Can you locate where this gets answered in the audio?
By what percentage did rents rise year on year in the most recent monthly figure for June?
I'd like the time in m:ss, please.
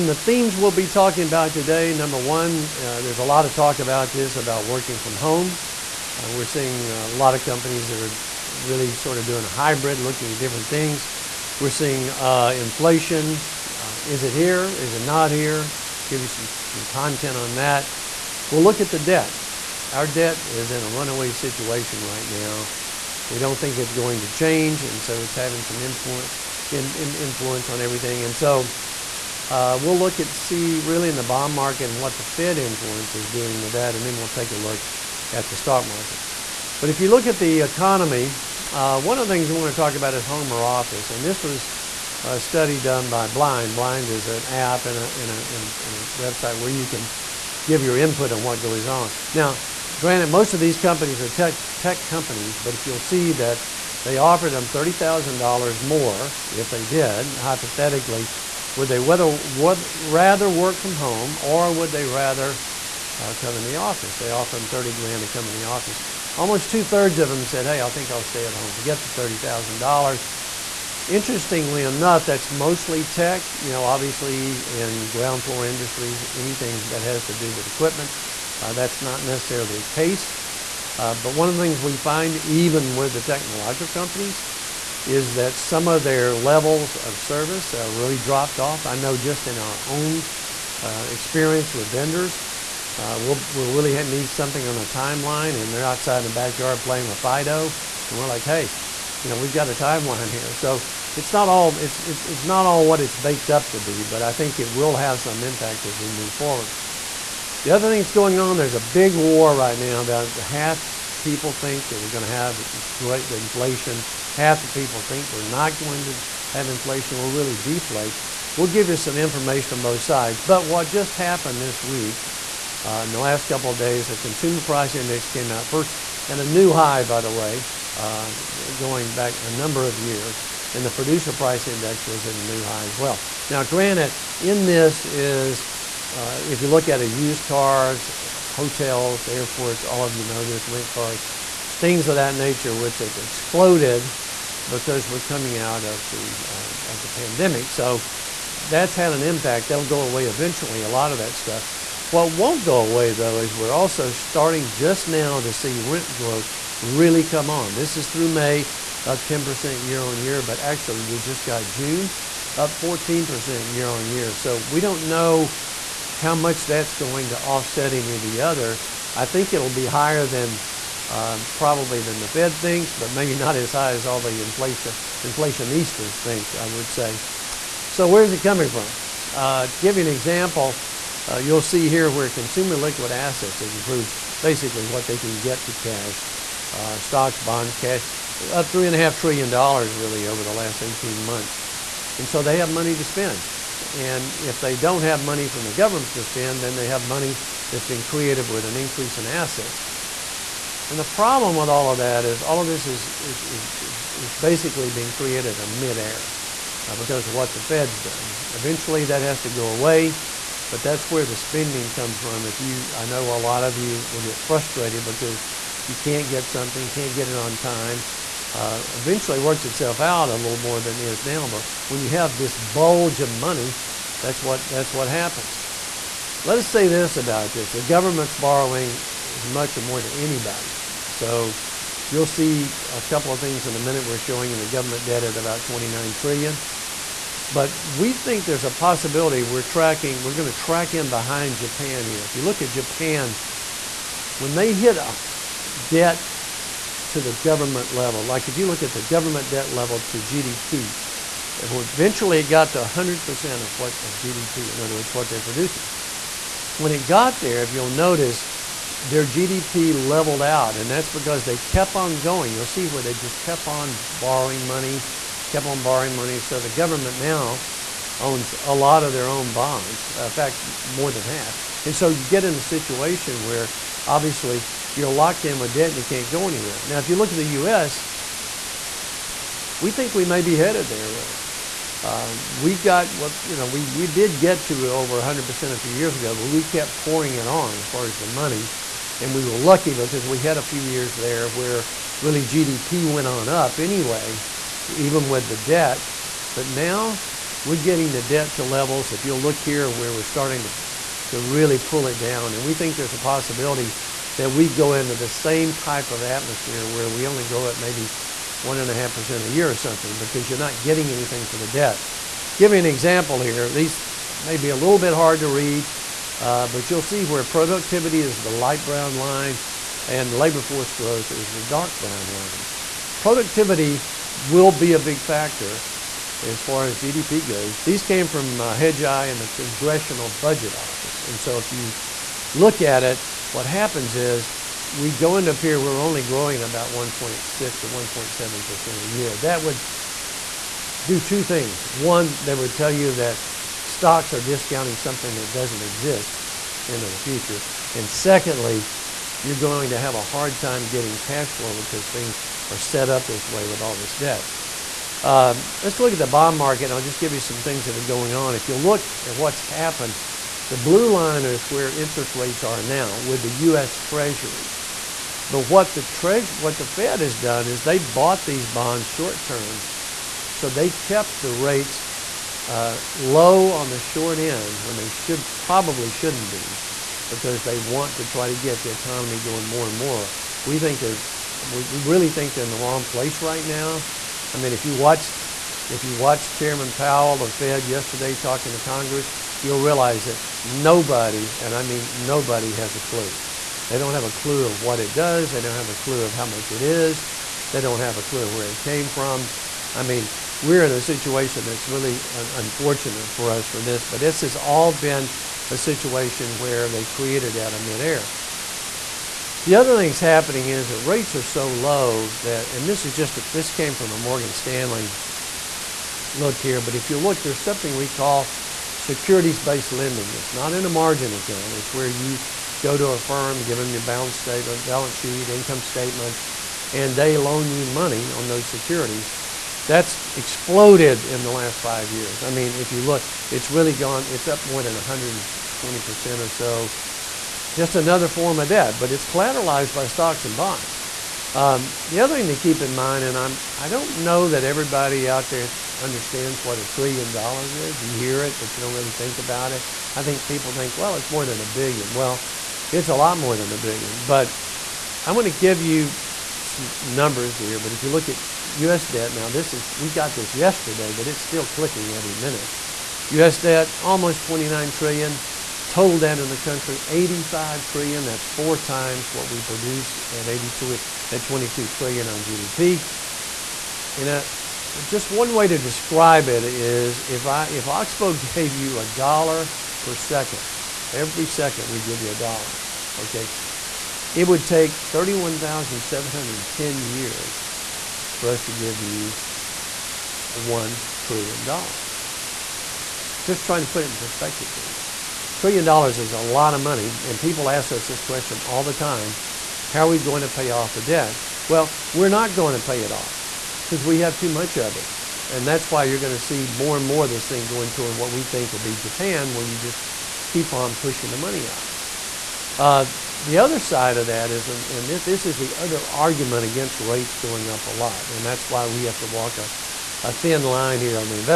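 2:42.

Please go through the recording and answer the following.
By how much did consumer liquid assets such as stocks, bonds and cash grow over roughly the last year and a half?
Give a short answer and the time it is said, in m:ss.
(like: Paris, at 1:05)
$3.5 trillion, at 3:08.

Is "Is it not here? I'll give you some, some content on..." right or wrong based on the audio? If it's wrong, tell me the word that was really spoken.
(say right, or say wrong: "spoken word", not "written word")
right.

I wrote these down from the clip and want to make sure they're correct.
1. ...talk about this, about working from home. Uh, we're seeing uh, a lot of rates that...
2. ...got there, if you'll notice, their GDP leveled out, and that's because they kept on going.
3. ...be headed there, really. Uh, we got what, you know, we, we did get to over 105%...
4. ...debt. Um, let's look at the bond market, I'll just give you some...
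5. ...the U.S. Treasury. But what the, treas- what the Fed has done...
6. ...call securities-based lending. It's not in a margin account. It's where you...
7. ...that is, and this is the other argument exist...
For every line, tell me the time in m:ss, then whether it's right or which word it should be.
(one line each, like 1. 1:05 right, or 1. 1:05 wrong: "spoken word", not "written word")
1. 0:03 wrong: "companies", not "rates"
2. 4:17 right
3. 4:40 wrong: "100", not "105"
4. 5:54 right
5. 6:03 right
6. 6:58 right
7. 8:34 wrong: "against", not "exist".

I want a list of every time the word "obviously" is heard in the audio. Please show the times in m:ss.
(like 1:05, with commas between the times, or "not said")
1:13, 4:34.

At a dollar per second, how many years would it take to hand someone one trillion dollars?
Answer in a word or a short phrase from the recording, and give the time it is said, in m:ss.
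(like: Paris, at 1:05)
31,710 years, at 8:05.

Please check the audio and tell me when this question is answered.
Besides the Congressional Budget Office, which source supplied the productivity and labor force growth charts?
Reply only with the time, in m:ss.
5:28.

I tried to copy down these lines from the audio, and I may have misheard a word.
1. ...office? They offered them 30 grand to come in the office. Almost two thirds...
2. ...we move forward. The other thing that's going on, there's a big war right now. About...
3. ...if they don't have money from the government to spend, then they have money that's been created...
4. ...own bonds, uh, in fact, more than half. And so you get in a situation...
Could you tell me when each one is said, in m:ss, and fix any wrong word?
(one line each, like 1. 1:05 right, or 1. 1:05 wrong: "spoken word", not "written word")
1. 1:03 right
2. 1:45 right
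3. 3:14 right
4. 4:29 right.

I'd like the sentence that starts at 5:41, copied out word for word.
One, that would tell you that stocks are discounting something that doesn't exist into the future.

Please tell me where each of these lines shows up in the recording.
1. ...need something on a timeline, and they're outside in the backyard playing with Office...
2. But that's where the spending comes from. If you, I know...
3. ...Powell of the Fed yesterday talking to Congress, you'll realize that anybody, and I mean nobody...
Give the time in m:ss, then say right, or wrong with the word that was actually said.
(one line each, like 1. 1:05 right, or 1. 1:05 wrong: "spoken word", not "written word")
1. 1:34 wrong: "Fido", not "Office"
2. 3:30 right
3. 6:26 wrong: "nobody", not "anybody".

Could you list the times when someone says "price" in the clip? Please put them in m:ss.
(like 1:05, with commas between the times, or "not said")
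2:04, 2:11.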